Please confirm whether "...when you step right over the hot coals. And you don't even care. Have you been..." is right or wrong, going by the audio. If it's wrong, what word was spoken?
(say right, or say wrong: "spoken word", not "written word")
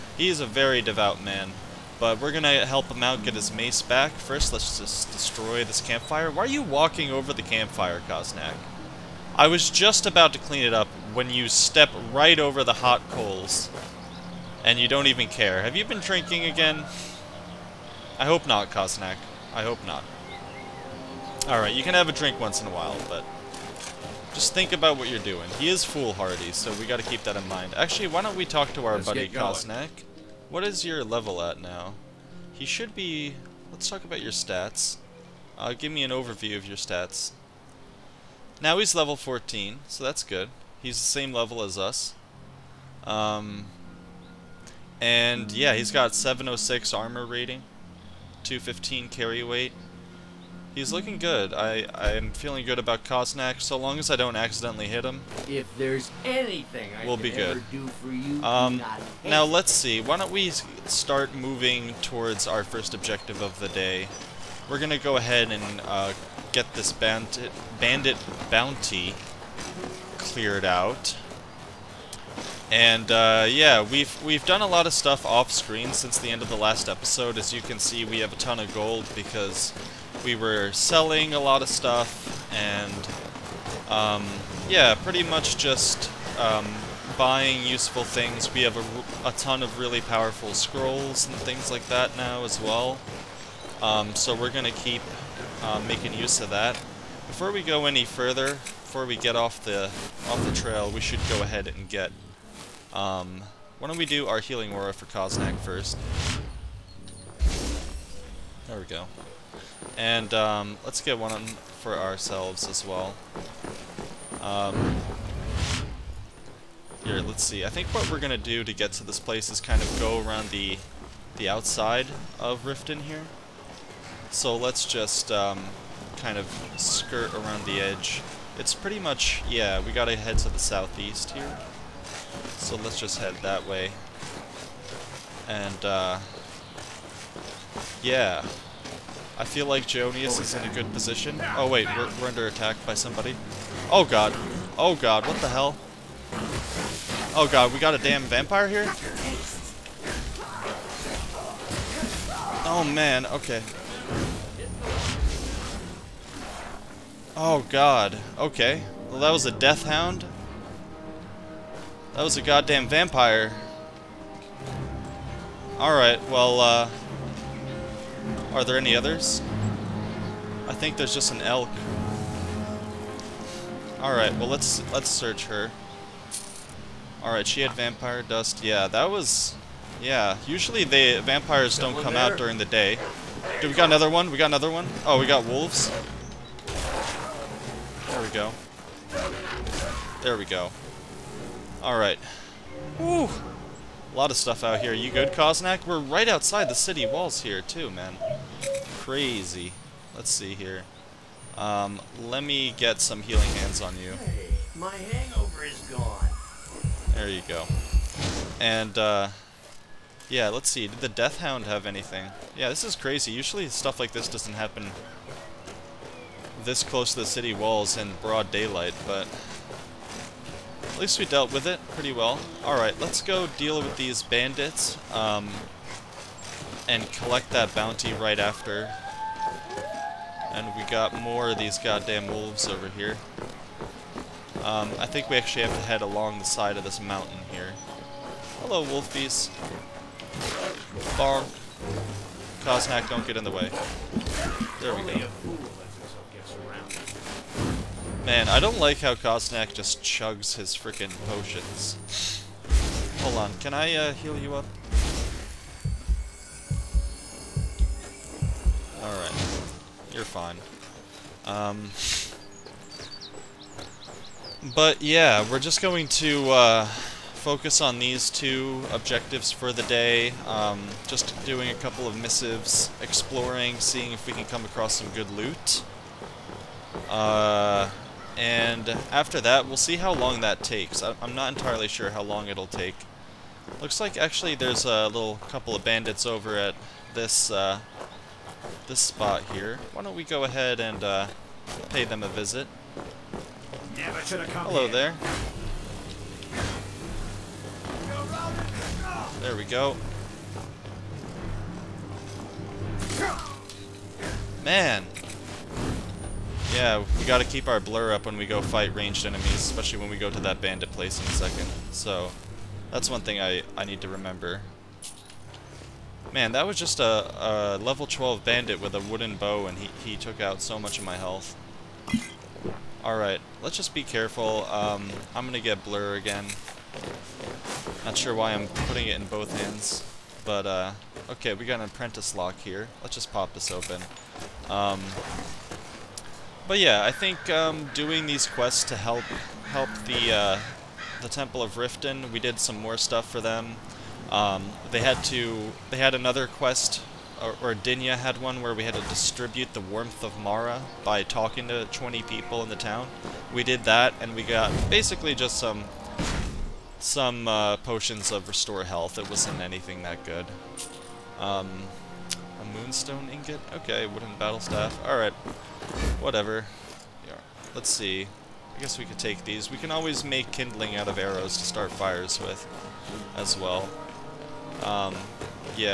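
right.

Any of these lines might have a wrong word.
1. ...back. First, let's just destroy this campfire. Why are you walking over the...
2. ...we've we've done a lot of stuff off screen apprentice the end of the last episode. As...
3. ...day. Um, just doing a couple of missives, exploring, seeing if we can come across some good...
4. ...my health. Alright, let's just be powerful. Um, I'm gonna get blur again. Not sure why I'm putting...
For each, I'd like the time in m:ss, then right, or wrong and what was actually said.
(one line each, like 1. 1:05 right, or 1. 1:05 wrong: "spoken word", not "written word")
1. 0:03 right
2. 1:13 wrong: "since", not "apprentice"
3. 4:29 right
4. 5:21 wrong: "careful", not "powerful".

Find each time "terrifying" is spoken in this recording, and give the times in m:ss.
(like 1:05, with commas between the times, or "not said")
not said.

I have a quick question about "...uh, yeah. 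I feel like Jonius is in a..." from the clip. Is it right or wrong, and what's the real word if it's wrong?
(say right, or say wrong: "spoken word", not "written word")
right.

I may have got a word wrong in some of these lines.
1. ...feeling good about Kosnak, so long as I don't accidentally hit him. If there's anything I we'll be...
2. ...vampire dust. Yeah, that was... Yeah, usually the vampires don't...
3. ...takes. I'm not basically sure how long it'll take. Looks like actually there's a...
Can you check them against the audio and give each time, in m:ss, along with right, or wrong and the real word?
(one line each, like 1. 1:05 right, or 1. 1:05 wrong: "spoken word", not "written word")
1. 0:52 right
2. 2:57 right
3. 4:40 wrong: "entirely", not "basically".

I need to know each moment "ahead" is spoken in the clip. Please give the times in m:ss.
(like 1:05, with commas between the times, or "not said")
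1:05, 1:41, 4:50.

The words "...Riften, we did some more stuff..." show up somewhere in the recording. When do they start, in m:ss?
5:41.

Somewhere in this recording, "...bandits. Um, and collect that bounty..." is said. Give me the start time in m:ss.
3:44.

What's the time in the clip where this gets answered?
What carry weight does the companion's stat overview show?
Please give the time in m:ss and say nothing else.
0:48.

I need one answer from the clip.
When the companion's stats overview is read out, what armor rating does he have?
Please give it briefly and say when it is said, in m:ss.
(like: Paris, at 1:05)
706, at 0:46.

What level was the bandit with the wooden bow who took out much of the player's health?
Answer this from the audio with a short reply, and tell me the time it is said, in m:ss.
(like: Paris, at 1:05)
12, at 5:17.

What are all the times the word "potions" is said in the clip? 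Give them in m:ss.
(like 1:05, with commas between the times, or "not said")
4:11, 5:57.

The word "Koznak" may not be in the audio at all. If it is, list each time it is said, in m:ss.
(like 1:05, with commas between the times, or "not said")
1:45, 3:15.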